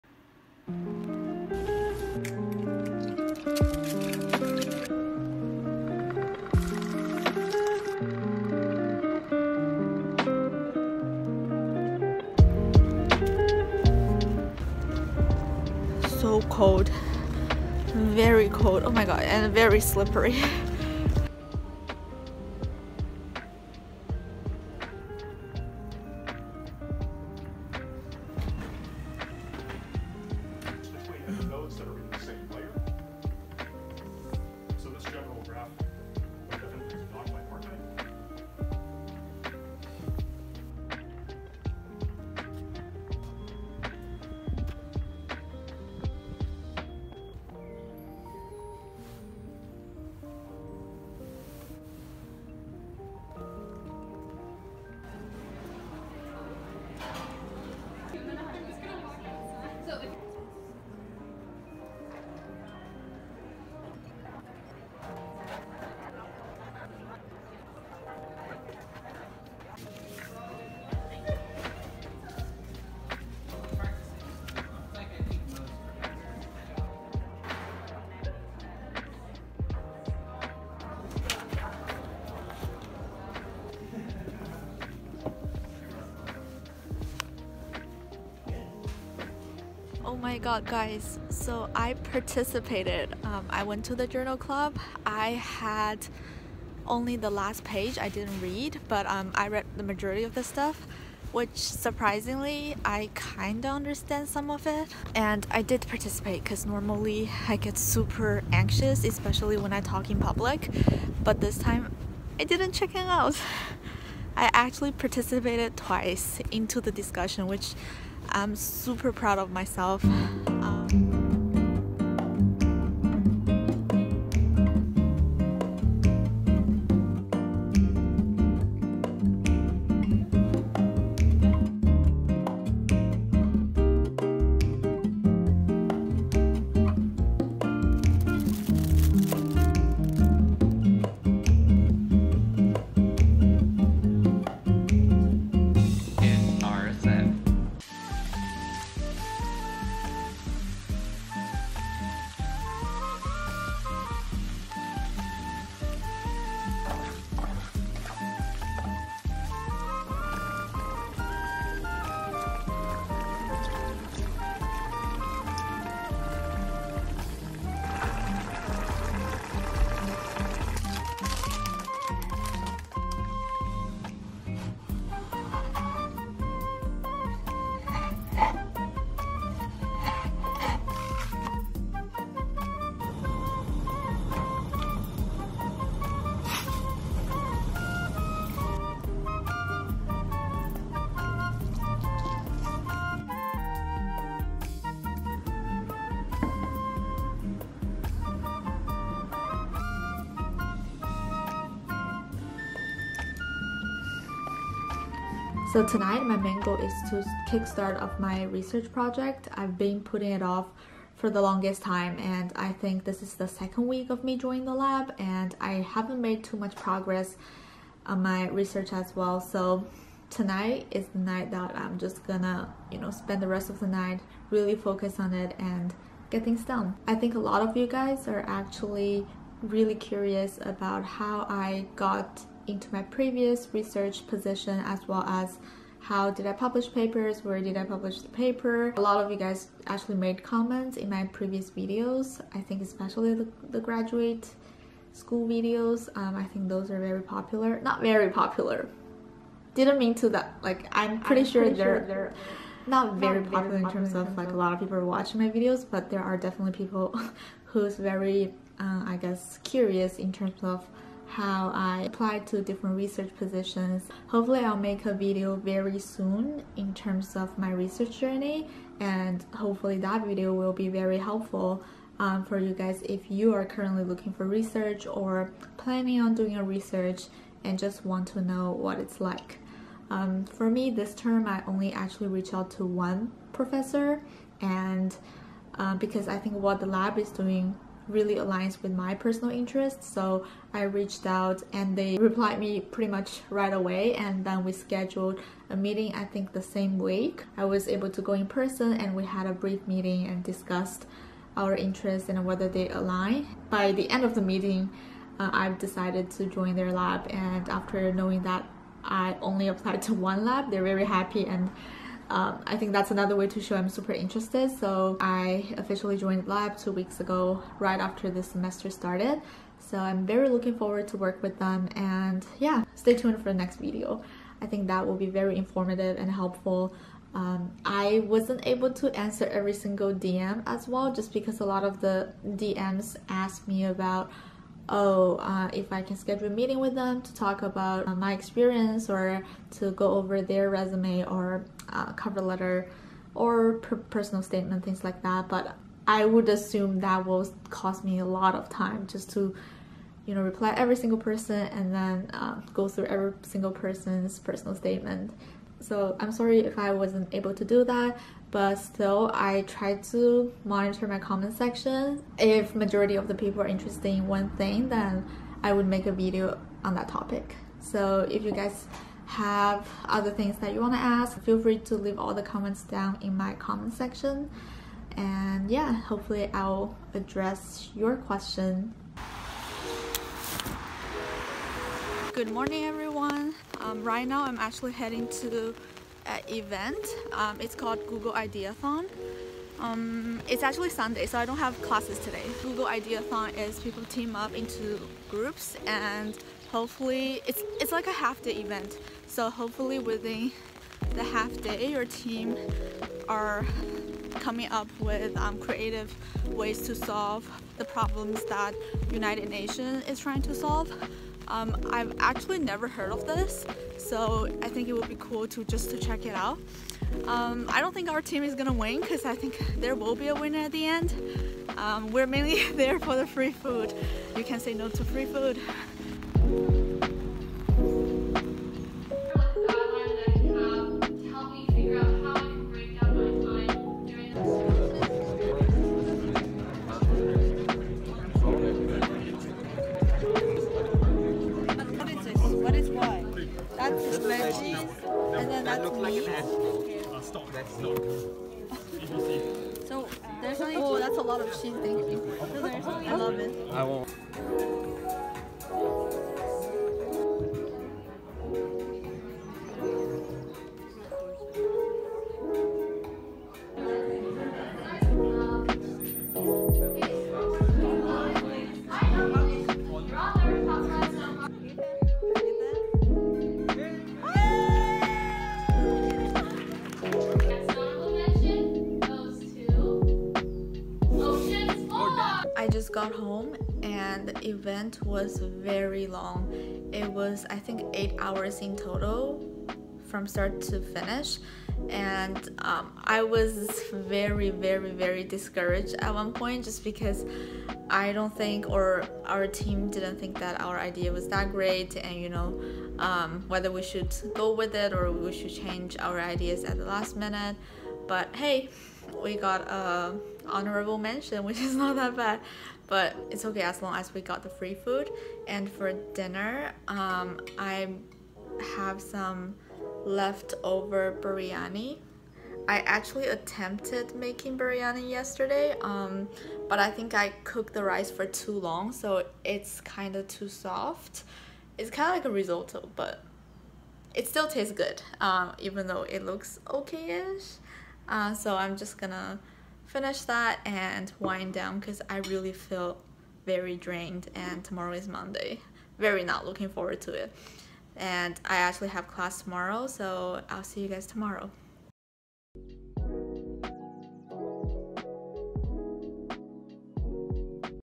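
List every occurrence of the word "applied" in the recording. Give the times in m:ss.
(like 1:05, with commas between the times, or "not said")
4:22, 5:09.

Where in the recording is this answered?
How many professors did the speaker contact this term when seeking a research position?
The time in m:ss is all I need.
4:42.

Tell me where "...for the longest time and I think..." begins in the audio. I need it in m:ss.
3:31.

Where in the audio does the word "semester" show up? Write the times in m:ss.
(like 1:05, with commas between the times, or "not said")
5:18.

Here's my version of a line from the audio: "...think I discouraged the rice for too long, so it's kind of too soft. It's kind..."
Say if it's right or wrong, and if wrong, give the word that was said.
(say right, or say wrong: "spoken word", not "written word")
wrong: "cooked", not "discouraged".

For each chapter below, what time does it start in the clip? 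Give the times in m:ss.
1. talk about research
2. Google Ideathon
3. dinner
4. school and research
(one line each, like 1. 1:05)
1. 3:25
2. 6:22
3. 2:27
4. 0:25.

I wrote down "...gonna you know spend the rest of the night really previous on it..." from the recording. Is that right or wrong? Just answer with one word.
wrong.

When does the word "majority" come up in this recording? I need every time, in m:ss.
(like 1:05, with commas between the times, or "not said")
1:39, 6:02.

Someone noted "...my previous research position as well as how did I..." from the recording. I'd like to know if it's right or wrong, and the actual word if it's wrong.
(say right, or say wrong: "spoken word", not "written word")
right.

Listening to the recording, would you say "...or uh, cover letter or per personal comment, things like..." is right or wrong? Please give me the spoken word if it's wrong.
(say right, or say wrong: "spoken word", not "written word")
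wrong: "statement", not "comment".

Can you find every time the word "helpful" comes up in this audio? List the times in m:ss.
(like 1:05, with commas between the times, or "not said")
4:31, 5:26.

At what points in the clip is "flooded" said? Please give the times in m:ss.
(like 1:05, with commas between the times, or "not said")
not said.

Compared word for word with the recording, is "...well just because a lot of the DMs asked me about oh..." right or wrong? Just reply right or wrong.
right.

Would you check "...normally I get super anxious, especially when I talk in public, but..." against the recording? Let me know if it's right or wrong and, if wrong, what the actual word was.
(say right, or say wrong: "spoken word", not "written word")
right.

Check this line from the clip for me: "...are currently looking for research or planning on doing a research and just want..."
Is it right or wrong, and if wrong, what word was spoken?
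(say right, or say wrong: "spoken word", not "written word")
right.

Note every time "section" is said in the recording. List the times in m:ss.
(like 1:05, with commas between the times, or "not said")
6:01, 6:13.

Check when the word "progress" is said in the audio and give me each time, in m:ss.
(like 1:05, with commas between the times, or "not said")
3:36.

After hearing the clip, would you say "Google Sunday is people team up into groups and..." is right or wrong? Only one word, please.
wrong.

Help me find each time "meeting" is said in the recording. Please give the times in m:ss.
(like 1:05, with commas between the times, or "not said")
4:55, 4:59, 5:04, 5:36.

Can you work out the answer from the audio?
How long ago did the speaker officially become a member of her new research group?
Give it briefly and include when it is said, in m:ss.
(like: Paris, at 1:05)
2 weeks, at 5:16.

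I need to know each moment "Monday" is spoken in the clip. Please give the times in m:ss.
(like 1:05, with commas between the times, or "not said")
9:05.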